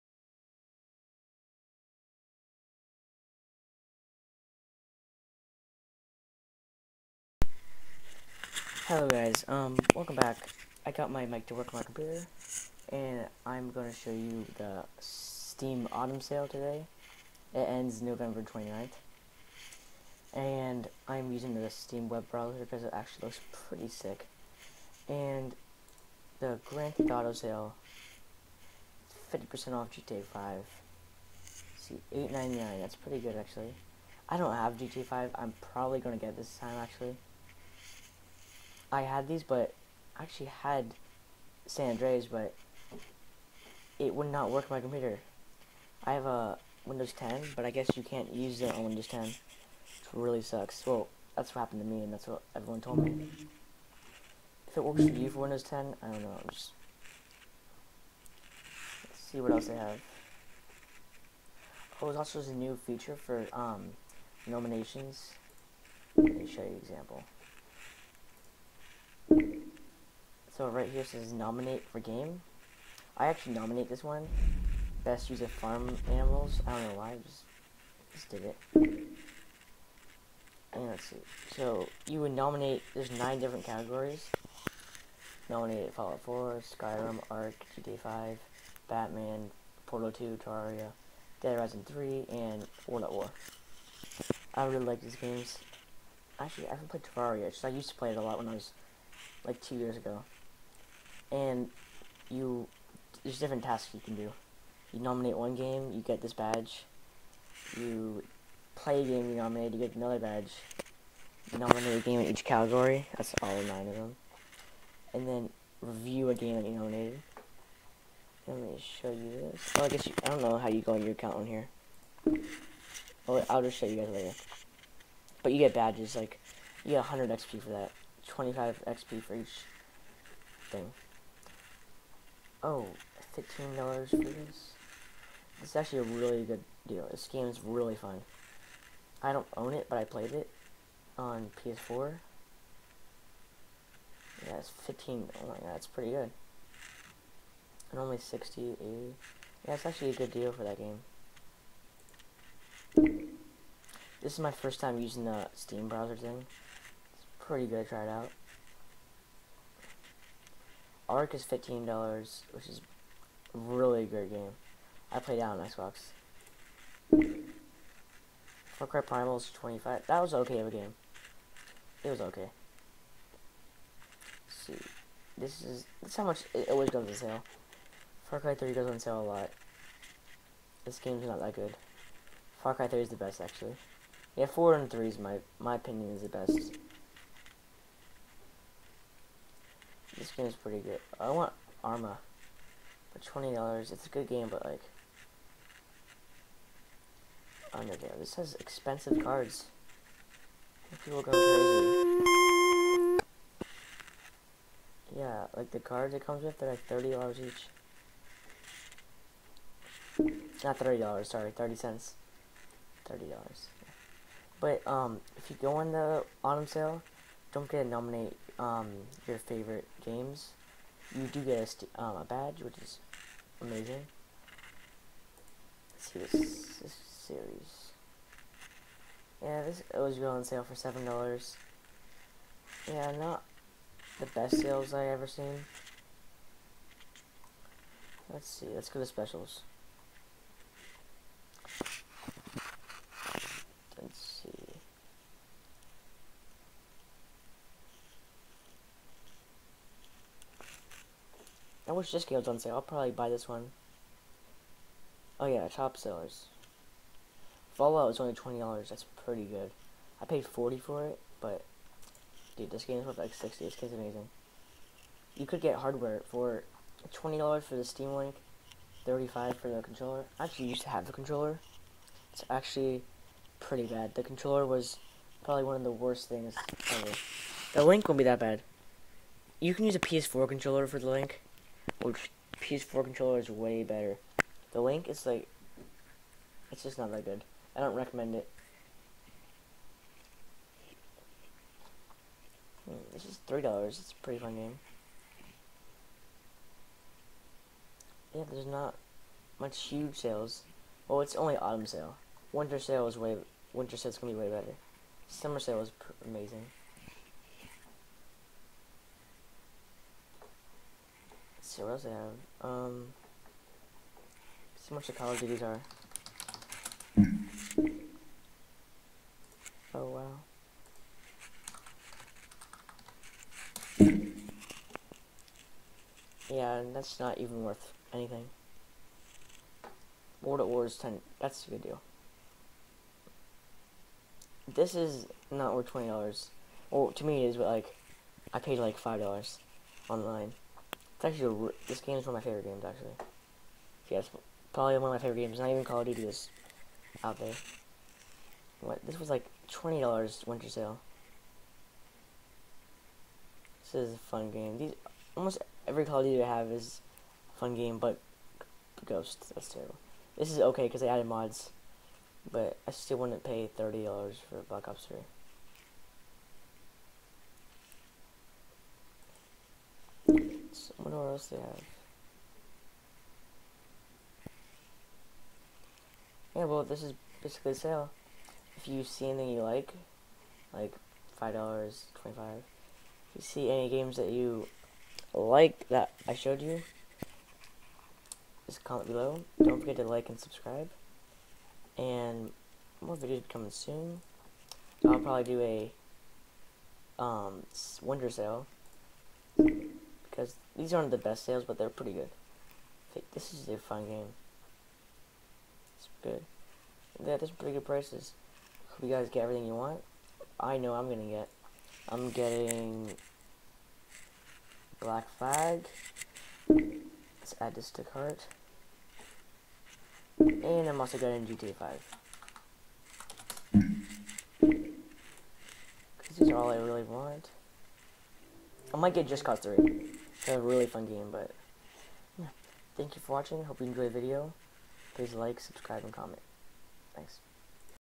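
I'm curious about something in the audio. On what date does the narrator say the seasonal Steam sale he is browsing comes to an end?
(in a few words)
November 29th.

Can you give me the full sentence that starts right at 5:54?
These almost every Call of Duty I have is a fun game, but Ghost.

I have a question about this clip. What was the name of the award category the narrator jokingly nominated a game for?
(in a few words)
Best use of farm animals.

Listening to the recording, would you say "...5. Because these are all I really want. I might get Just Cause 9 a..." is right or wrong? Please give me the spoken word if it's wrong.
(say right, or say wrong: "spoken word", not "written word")
wrong: "3", not "9".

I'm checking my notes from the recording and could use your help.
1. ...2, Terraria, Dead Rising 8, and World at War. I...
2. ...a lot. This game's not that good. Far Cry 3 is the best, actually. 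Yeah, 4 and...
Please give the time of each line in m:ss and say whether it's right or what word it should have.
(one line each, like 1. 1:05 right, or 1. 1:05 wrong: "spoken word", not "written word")
1. 1:30 wrong: "3", not "8"
2. 2:59 right.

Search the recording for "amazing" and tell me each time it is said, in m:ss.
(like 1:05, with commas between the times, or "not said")
3:43, 4:23, 5:06.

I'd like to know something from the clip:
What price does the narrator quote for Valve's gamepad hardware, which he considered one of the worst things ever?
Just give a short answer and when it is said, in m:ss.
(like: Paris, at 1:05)
$35, at 4:29.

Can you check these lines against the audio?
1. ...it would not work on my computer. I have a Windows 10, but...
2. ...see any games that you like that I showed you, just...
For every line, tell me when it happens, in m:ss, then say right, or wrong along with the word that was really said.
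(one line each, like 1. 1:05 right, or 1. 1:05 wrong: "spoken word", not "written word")
1. 0:43 right
2. 6:23 right.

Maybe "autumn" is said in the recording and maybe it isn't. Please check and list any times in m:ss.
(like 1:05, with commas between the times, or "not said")
0:15, 3:36, 5:01.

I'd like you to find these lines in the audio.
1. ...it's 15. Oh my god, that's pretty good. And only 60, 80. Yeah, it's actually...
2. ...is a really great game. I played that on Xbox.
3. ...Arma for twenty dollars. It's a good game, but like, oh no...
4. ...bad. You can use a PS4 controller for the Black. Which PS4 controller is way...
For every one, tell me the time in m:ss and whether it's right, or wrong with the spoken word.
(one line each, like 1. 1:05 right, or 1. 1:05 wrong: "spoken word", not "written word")
1. 2:24 right
2. 2:42 right
3. 3:11 right
4. 4:38 wrong: "Link", not "Black".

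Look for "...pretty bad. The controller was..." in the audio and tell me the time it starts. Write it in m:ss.
4:33.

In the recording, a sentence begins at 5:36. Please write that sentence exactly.
Well, to me it is, but like, I paid like $5 online.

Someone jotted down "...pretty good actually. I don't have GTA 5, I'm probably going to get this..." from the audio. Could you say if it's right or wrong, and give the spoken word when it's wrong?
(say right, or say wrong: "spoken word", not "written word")
right.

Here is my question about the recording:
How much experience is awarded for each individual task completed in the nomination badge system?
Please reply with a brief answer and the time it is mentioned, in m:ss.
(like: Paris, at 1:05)
25 XP, at 2:08.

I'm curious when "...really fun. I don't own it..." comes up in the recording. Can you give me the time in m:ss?
2:17.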